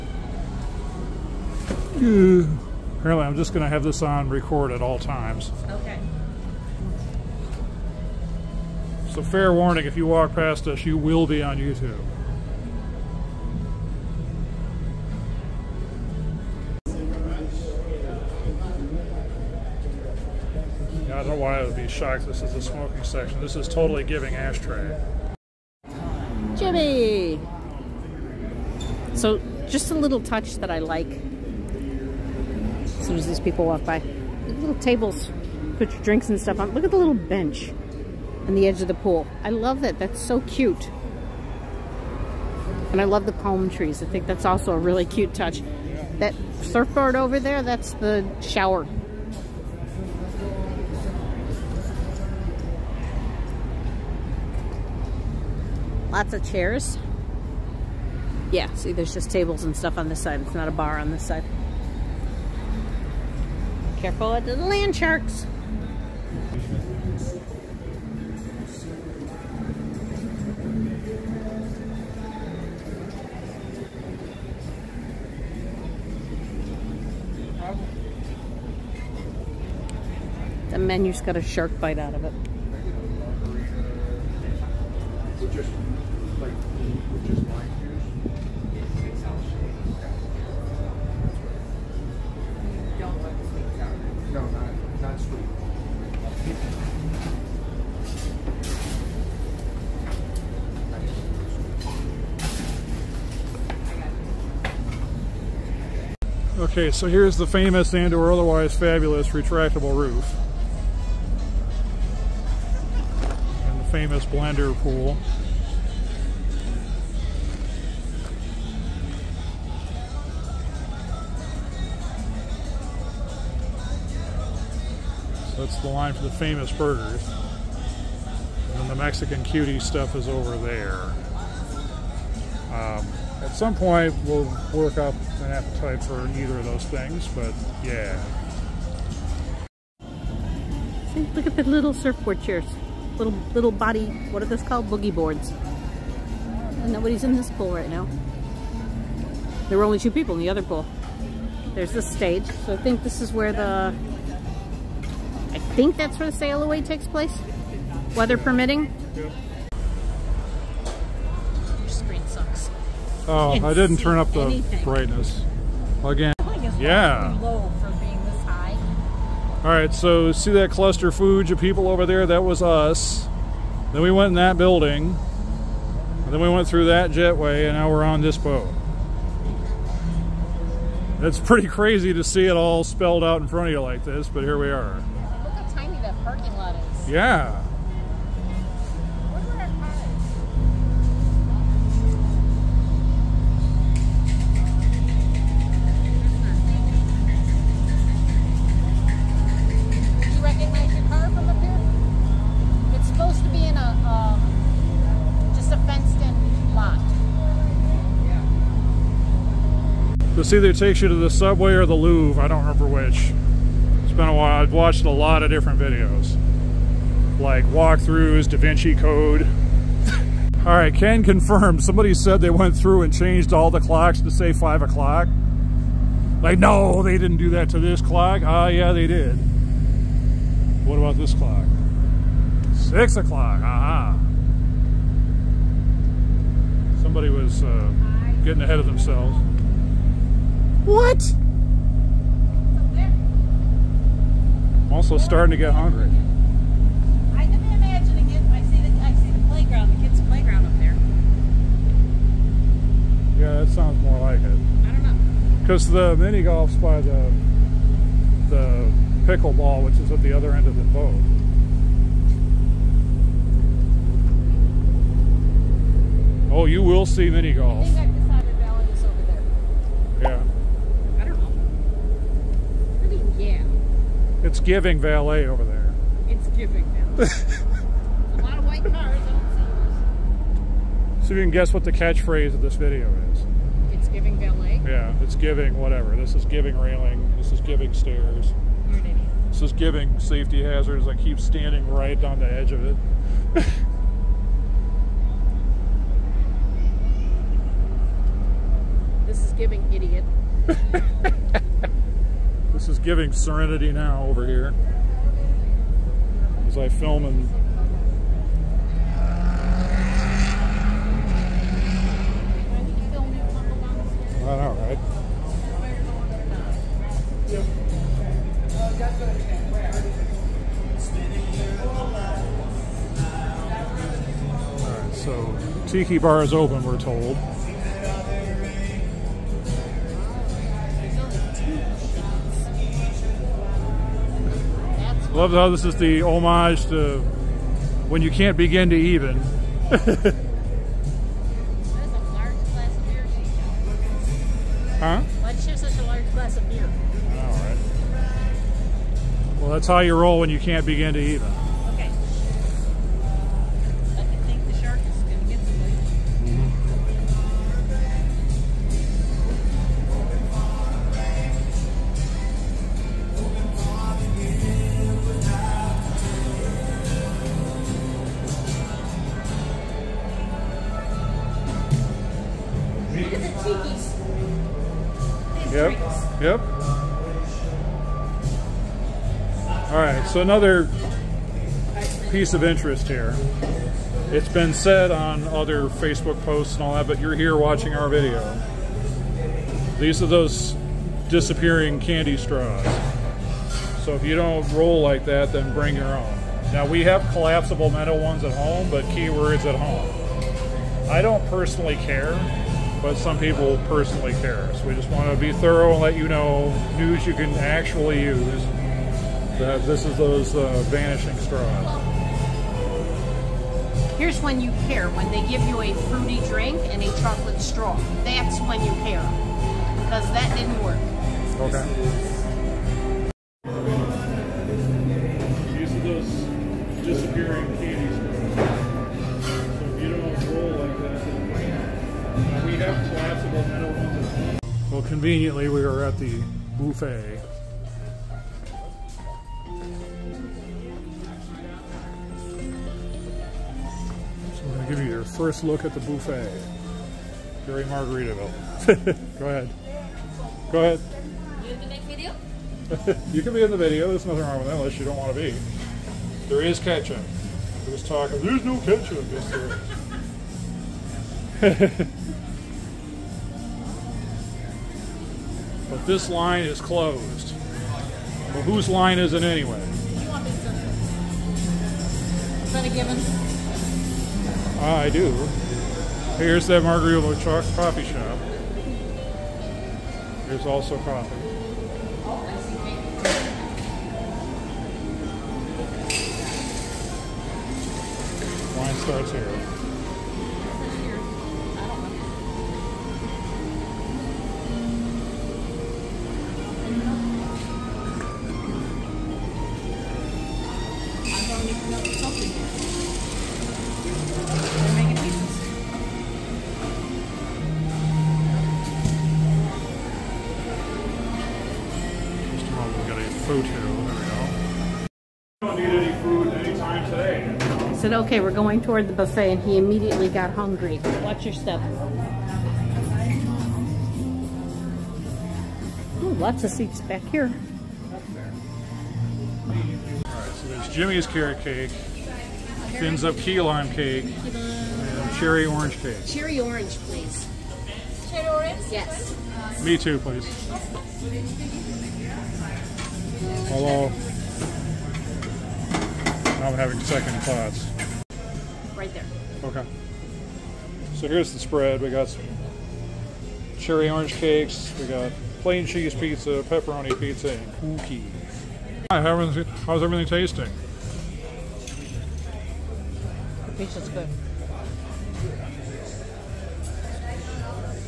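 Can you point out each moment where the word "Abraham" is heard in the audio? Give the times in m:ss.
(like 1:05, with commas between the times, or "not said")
not said.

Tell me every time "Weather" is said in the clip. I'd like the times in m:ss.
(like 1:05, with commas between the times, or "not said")
2:38.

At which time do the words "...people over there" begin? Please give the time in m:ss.
2:51.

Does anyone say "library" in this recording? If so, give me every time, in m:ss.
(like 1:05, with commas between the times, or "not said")
not said.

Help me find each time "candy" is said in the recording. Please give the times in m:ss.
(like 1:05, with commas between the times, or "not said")
6:32.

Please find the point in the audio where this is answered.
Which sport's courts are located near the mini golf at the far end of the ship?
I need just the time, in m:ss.
4:19.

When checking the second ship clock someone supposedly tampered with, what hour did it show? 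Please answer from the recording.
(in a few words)
6 o'clock.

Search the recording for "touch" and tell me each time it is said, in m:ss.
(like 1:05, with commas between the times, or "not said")
0:30, 0:45.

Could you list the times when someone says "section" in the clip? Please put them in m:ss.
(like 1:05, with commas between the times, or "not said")
0:23.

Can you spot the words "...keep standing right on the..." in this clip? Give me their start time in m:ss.
4:51.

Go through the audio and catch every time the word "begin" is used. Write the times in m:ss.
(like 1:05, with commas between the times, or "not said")
5:38, 5:50.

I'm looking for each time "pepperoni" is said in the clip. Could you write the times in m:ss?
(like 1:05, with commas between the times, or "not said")
9:16.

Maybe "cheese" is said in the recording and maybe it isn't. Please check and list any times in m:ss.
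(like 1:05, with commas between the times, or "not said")
9:15.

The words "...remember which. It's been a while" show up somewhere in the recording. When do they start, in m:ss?
3:32.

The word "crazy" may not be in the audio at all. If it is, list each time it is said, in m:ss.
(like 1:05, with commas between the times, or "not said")
3:01.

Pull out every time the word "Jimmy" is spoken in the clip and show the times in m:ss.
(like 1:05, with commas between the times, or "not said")
0:26, 8:50.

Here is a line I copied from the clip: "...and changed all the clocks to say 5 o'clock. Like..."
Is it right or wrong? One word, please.
right.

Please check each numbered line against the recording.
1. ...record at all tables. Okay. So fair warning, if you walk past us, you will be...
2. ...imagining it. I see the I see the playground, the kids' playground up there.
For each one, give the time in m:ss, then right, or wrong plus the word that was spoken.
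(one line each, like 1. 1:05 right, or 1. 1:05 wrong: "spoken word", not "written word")
1. 0:04 wrong: "times", not "tables"
2. 4:07 right.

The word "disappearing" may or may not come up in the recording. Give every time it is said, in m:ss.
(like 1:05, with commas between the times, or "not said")
6:31, 7:07.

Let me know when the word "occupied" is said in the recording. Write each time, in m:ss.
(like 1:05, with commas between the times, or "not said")
not said.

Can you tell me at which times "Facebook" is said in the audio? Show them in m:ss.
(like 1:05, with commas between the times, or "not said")
6:25.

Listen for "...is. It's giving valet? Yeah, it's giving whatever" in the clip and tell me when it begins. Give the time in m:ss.
4:43.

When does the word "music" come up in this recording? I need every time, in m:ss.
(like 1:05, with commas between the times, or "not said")
not said.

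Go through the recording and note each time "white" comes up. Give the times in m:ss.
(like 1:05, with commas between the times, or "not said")
4:38.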